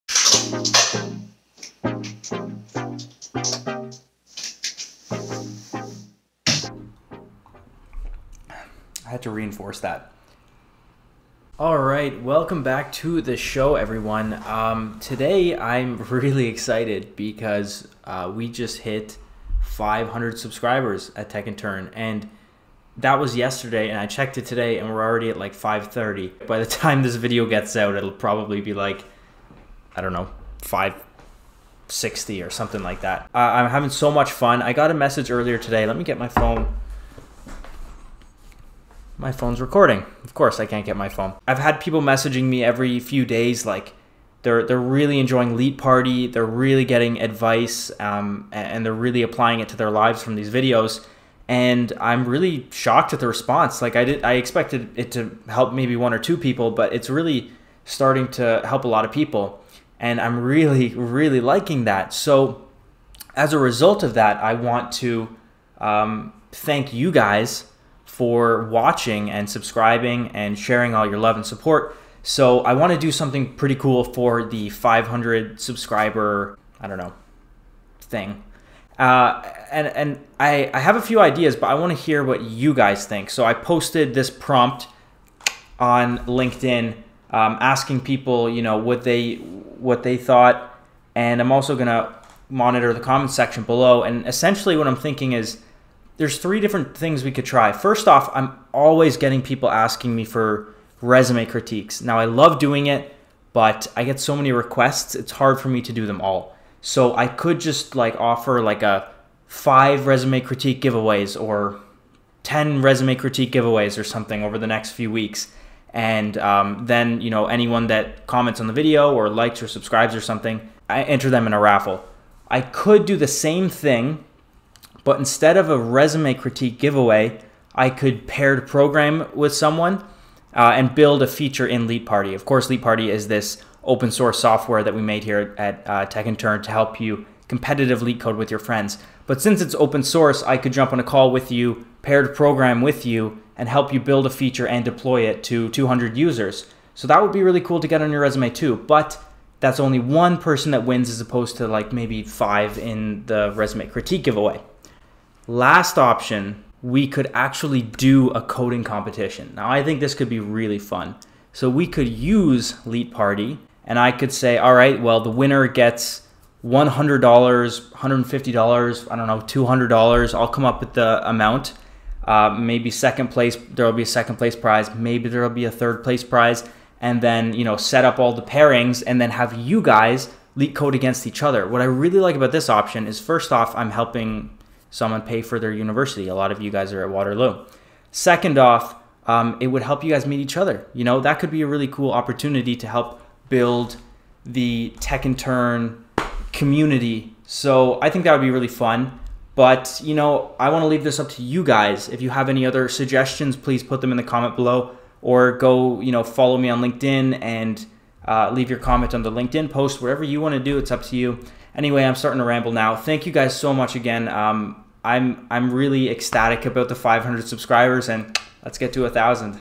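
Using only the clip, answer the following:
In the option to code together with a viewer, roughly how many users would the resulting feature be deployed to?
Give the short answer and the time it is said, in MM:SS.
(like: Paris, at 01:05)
200, at 02:25.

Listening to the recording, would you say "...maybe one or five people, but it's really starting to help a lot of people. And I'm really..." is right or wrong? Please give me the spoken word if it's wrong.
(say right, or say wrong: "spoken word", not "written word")
wrong: "two", not "five".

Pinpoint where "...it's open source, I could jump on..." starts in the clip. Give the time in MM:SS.
02:19.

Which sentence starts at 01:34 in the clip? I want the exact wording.
And essentially, what I'm thinking is there's three different things we could try.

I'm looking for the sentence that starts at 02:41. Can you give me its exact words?
So we could use Leet Party, and I could say, all right, well, the winner gets $100, $150, I don't know, $200.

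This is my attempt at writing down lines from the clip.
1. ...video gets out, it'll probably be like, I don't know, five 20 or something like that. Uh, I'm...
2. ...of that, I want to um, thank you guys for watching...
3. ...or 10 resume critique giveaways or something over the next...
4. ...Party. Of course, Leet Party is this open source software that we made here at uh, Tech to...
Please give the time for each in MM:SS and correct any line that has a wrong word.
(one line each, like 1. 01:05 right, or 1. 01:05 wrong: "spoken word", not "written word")
1. 00:27 wrong: "60", not "20"
2. 01:04 right
3. 01:51 right
4. 02:12 right.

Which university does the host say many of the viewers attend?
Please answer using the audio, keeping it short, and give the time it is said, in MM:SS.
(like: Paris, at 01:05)
Waterloo, at 03:07.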